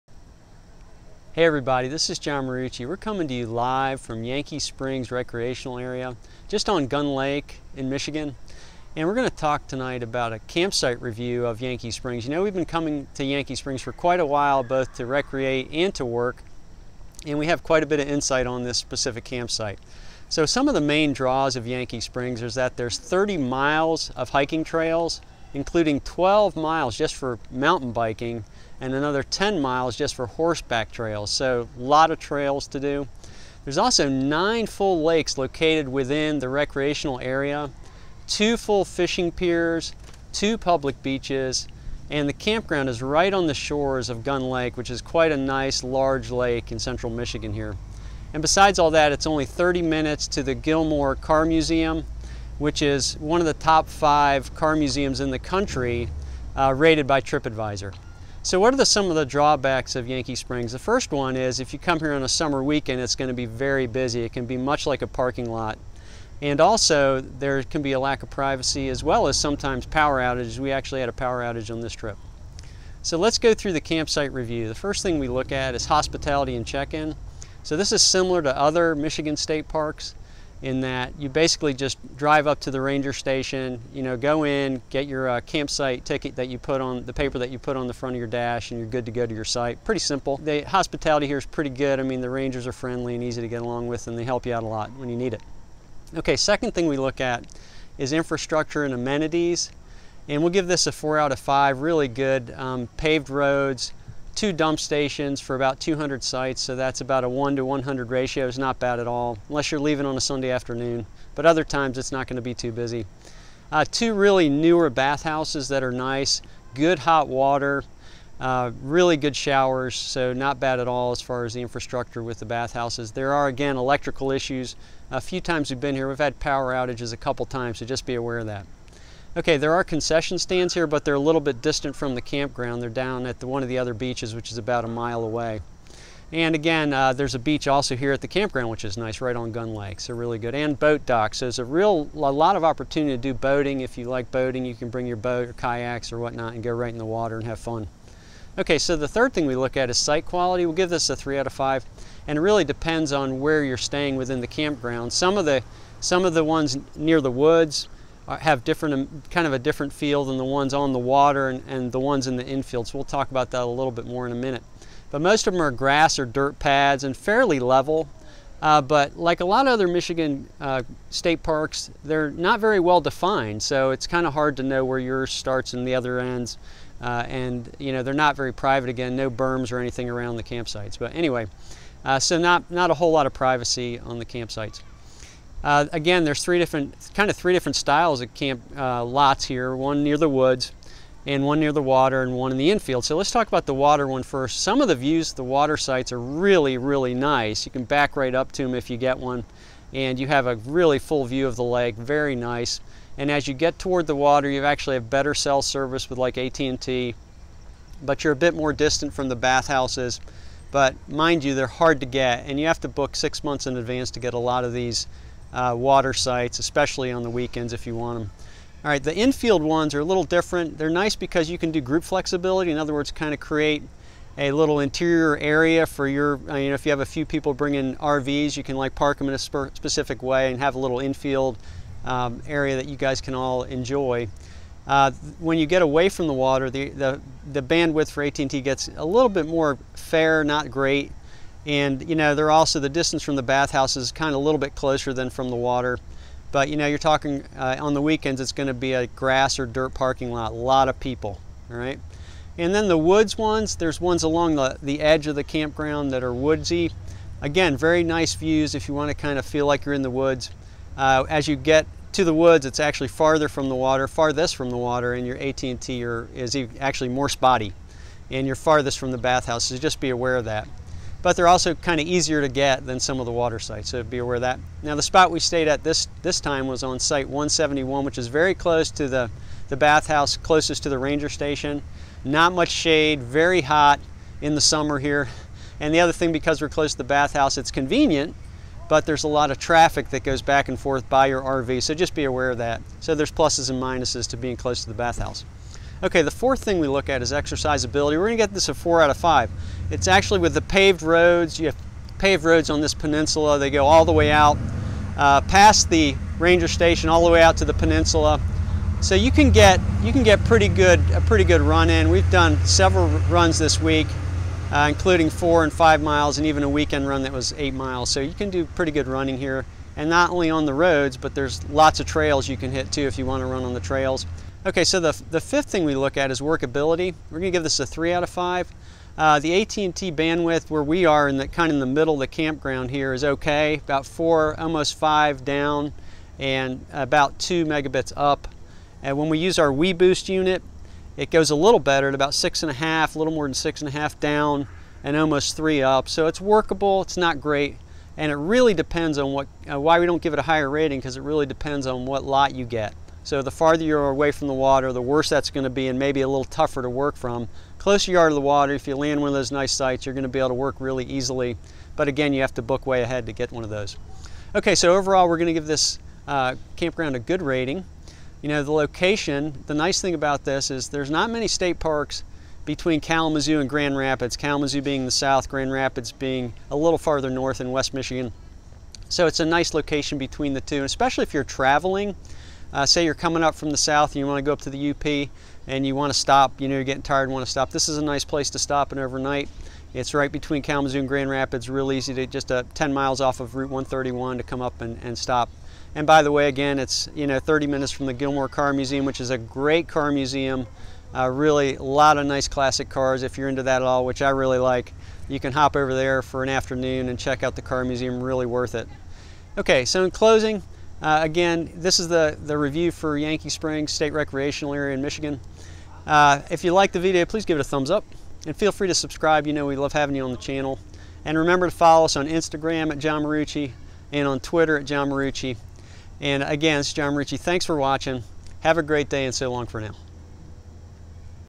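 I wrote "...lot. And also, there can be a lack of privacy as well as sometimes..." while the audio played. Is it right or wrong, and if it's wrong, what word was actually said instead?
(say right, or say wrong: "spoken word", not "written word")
right.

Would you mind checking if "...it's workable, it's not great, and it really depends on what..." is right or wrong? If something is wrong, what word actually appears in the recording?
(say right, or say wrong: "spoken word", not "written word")
right.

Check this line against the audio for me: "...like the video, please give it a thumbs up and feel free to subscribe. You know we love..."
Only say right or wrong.
right.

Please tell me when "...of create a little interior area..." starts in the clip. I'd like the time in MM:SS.
03:43.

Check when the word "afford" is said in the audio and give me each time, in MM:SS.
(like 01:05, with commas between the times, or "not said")
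not said.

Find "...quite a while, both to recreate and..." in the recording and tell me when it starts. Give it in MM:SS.
00:13.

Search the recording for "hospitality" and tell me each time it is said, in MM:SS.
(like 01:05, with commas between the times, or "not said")
01:15, 01:30.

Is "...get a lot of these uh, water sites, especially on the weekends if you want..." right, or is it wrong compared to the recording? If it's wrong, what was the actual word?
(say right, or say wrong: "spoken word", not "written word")
right.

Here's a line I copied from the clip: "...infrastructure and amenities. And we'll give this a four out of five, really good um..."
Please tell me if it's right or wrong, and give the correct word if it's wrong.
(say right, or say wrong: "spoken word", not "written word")
right.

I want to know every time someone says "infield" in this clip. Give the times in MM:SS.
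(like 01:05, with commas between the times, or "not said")
02:42, 03:12, 03:39, 03:50.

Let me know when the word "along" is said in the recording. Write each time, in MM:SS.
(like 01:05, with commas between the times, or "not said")
01:33, 04:14.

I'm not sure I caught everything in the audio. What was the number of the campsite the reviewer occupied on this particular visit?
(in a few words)
171.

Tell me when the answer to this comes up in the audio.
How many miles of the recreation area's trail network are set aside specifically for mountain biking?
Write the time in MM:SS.
00:26.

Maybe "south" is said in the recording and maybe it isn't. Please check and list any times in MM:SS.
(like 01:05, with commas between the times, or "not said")
06:15, 06:23.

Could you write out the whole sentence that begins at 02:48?
Uh, but like a lot of other Michigan uh, state parks, they're not very well defined.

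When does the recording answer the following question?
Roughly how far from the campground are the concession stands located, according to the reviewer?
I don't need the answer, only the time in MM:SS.
02:14.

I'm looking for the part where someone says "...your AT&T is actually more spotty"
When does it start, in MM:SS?
04:25.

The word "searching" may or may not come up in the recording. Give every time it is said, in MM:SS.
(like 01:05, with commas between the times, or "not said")
not said.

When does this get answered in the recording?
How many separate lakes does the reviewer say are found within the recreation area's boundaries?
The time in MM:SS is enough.
00:34.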